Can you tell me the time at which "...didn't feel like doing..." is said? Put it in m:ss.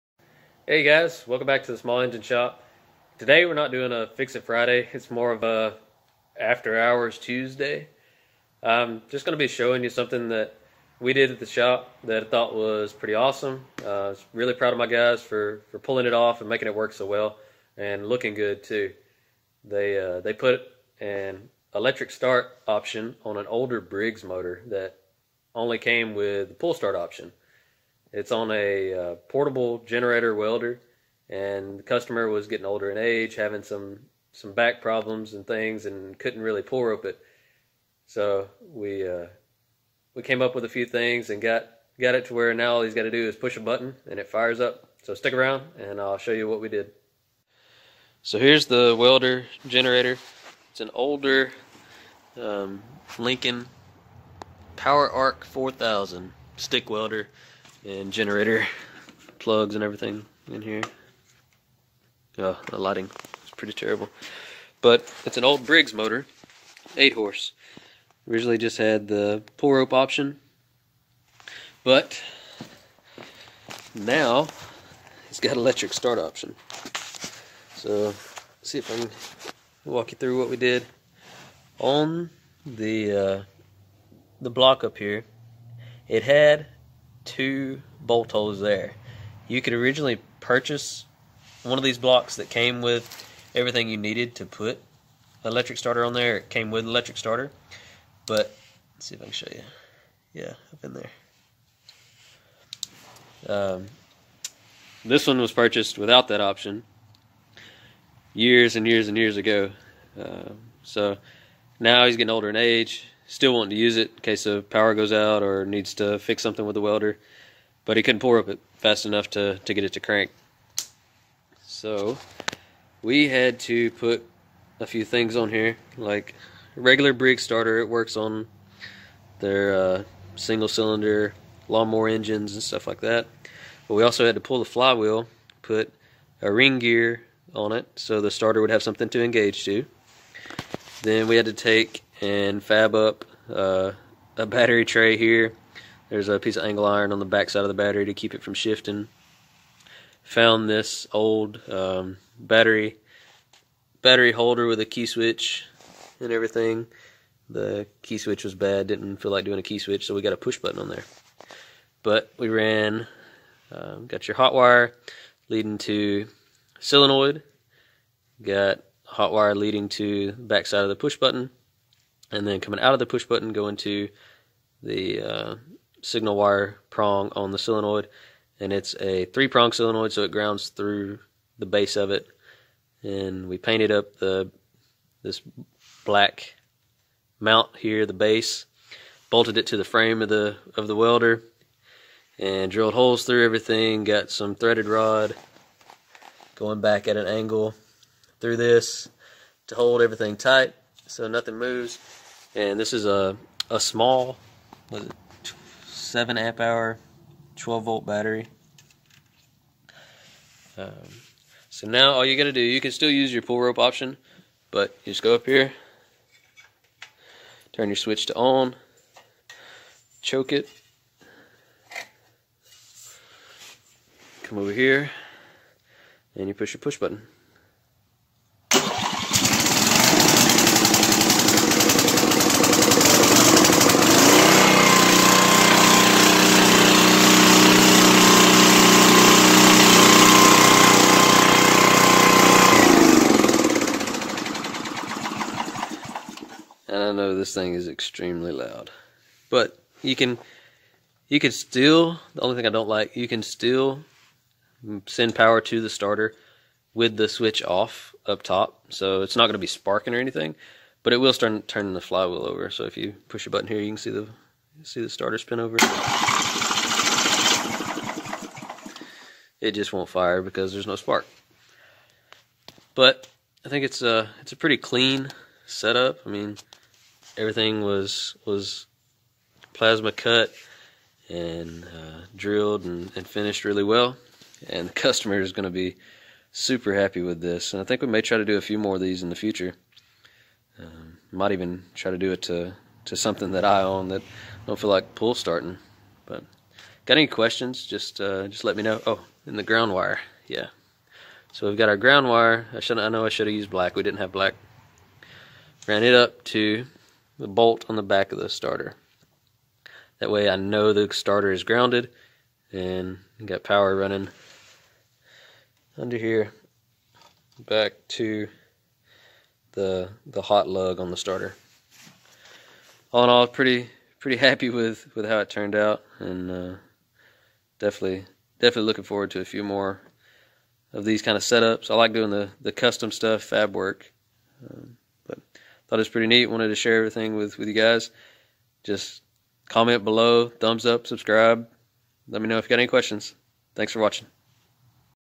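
2:38.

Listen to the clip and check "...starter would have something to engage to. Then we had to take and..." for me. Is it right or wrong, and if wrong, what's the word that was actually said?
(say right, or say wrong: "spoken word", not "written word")
right.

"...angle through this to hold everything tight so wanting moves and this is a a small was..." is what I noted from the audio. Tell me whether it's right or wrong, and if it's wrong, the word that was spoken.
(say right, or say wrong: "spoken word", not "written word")
wrong: "nothing", not "wanting".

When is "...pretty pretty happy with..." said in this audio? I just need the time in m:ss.
5:23.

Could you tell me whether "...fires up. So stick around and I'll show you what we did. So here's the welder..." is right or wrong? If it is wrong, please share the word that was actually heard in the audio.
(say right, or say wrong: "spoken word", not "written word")
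right.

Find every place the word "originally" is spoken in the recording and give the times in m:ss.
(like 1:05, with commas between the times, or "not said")
1:08, 1:29.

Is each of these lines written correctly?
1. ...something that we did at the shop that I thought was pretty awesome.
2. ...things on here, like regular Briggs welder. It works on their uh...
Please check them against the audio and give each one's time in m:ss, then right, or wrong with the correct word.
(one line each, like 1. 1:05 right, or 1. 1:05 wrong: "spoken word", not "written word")
1. 0:09 right
2. 2:05 wrong: "starter", not "welder".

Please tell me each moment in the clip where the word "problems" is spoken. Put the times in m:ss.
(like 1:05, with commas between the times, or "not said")
0:34.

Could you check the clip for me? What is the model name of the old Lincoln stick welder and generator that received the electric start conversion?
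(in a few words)
Power Arc 4000.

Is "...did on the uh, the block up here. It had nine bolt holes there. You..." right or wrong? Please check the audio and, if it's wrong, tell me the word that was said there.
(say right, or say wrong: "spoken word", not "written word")
wrong: "two", not "nine".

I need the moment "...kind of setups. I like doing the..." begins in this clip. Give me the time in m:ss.
5:31.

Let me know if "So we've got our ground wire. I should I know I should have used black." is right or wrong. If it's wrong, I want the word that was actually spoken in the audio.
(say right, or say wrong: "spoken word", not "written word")
right.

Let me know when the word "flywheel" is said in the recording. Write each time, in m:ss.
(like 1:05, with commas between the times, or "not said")
2:14, 4:21.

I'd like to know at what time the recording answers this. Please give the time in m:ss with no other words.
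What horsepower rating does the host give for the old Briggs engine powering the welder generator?
1:06.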